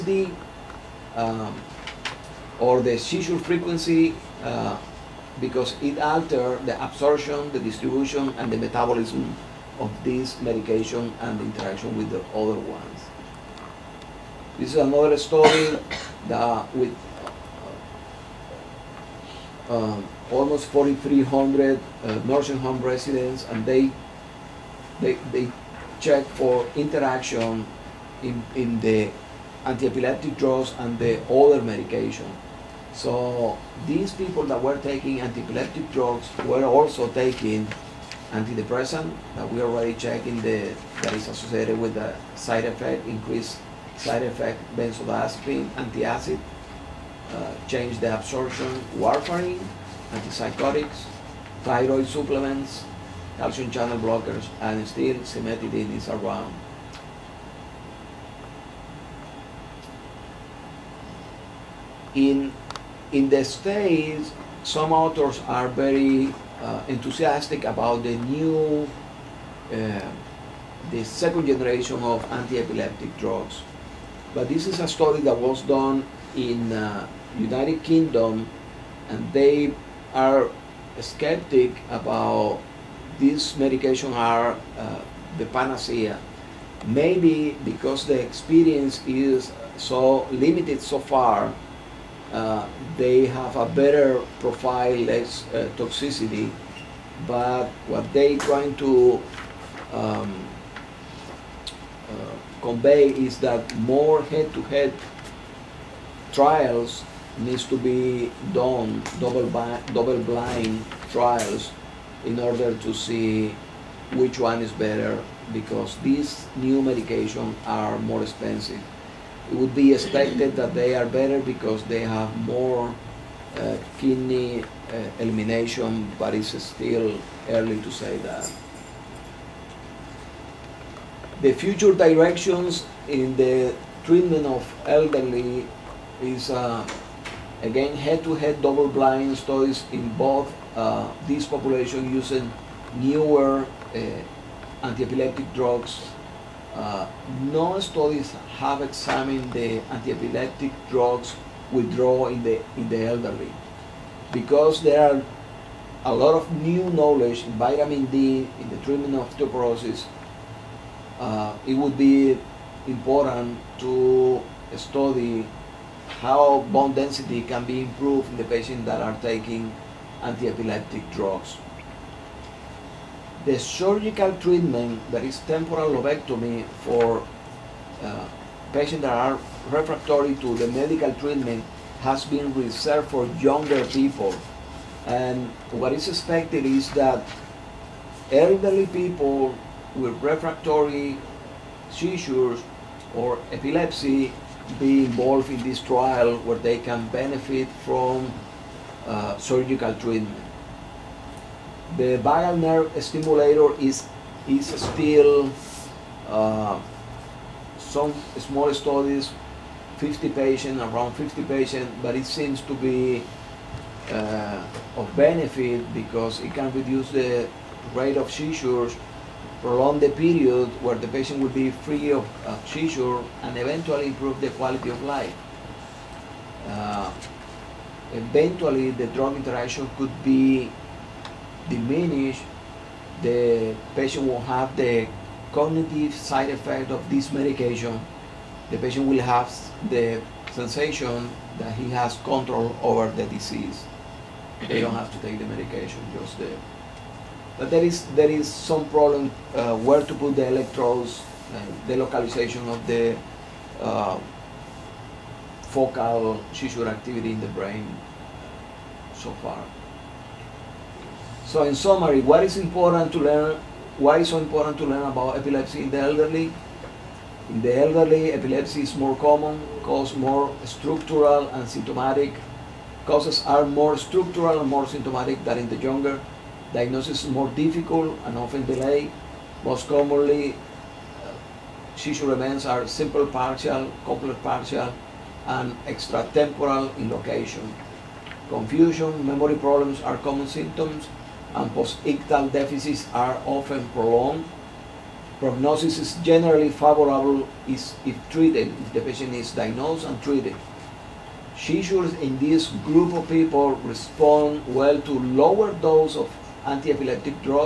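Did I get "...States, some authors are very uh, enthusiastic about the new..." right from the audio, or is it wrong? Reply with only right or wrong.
right.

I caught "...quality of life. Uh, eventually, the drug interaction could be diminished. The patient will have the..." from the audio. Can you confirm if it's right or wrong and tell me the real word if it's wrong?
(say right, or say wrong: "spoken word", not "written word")
right.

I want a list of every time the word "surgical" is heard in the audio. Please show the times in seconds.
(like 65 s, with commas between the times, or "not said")
173 s, 199 s.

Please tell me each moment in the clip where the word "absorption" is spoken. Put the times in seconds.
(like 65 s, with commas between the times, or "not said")
6 s, 48 s.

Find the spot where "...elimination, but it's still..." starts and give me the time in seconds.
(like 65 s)
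125 s.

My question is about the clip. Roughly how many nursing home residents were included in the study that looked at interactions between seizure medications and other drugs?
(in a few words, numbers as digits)
4,300.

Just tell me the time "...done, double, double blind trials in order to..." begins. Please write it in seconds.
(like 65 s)
108 s.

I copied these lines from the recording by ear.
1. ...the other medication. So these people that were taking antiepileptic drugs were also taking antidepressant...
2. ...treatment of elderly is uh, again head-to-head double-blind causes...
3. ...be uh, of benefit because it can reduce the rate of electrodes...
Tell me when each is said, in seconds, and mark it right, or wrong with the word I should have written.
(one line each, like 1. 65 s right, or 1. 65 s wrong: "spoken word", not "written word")
1. 30 s right
2. 134 s wrong: "studies", not "causes"
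3. 212 s wrong: "seizures", not "electrodes".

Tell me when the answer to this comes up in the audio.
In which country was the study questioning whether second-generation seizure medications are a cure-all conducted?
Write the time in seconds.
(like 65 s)
77 s.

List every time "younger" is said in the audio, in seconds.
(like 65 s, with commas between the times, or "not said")
183 s, 275 s.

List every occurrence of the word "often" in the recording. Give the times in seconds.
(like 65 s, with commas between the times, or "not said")
278 s, 293 s.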